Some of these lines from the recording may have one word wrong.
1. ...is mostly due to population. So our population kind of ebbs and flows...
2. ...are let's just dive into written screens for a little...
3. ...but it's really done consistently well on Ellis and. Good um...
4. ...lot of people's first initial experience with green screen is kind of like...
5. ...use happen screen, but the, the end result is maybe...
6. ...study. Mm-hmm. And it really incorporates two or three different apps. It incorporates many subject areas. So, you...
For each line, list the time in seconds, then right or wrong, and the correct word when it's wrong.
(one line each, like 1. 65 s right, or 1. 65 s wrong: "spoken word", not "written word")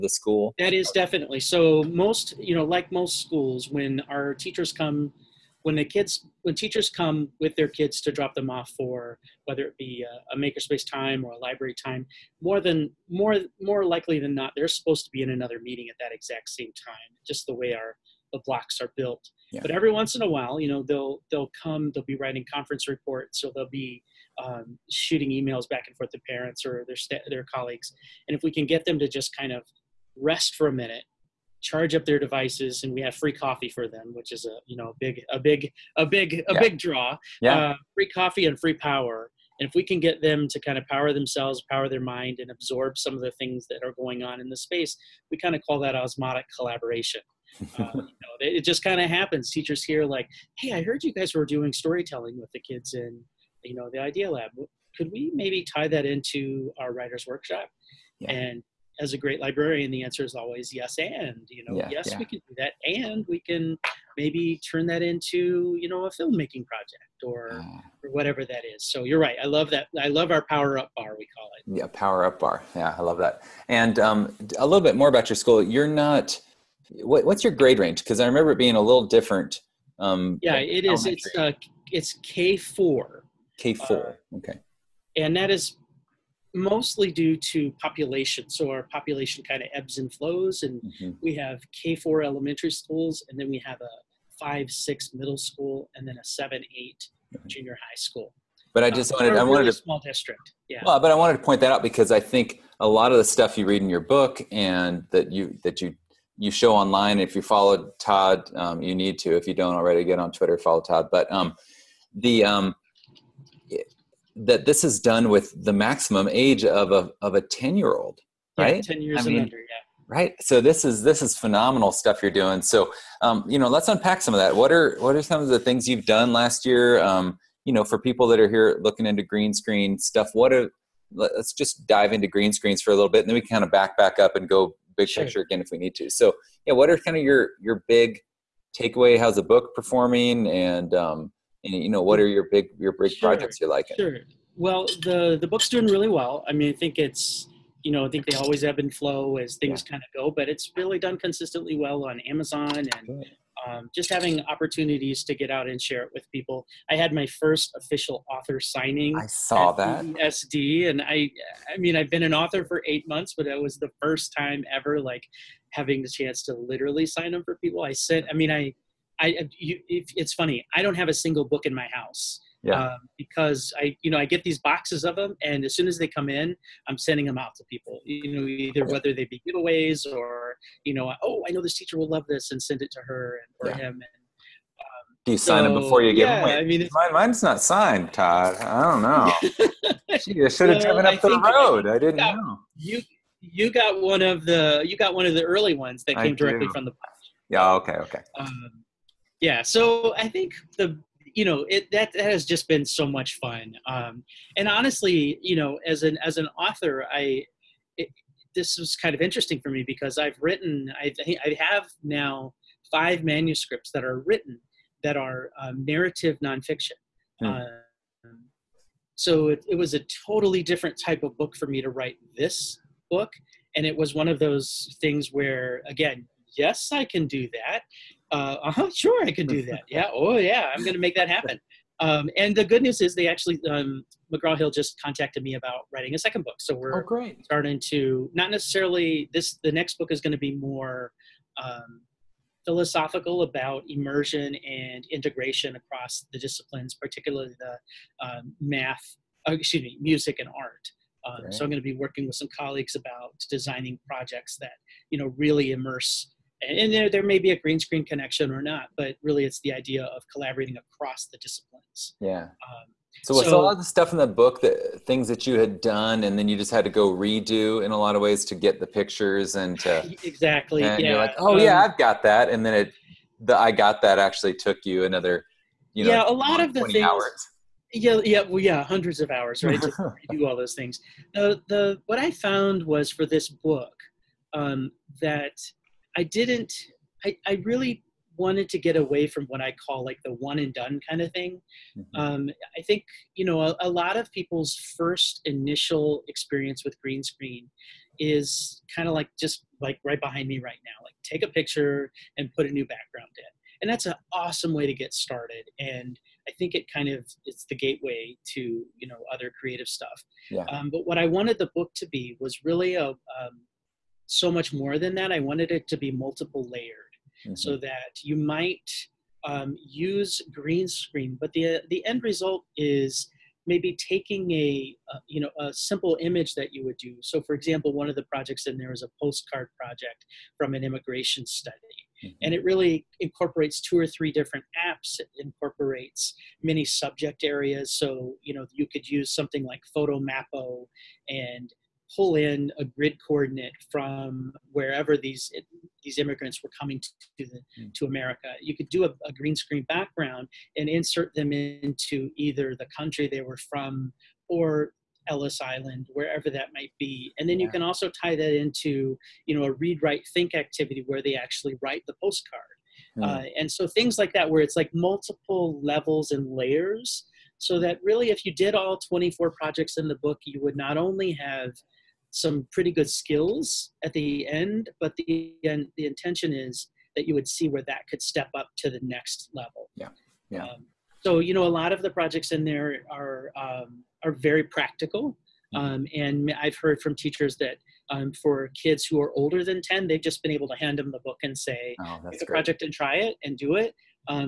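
1. 85 s right
2. 130 s wrong: "green", not "written"
3. 150 s wrong: "Amazon", not "Ellis"
4. 293 s right
5. 319 s wrong: "green", not "happen"
6. 331 s right.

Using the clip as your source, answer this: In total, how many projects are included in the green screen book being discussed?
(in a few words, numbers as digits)
24.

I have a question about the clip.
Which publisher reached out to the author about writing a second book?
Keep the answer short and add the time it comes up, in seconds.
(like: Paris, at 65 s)
McGraw Hill, at 234 s.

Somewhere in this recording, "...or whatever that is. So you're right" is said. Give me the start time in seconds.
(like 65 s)
68 s.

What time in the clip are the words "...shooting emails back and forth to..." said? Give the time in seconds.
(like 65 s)
24 s.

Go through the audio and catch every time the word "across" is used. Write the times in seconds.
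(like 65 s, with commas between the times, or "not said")
245 s, 260 s.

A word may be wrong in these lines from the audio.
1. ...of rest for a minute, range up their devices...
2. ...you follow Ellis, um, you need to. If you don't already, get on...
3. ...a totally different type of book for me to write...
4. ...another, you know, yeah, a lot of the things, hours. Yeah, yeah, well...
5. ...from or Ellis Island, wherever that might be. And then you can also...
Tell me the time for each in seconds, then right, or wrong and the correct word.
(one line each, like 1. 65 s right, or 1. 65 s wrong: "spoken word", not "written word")
1. 29 s wrong: "charge", not "range"
2. 107 s wrong: "Todd", not "Ellis"
3. 219 s right
4. 275 s right
5. 353 s right.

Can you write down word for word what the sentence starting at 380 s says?
Um, so you know, a lot of the projects in there are um, are very practical, mm-hmm.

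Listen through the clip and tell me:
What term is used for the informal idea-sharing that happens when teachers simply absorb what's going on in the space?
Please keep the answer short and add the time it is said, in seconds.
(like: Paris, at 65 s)
osmotic collaboration, at 45 s.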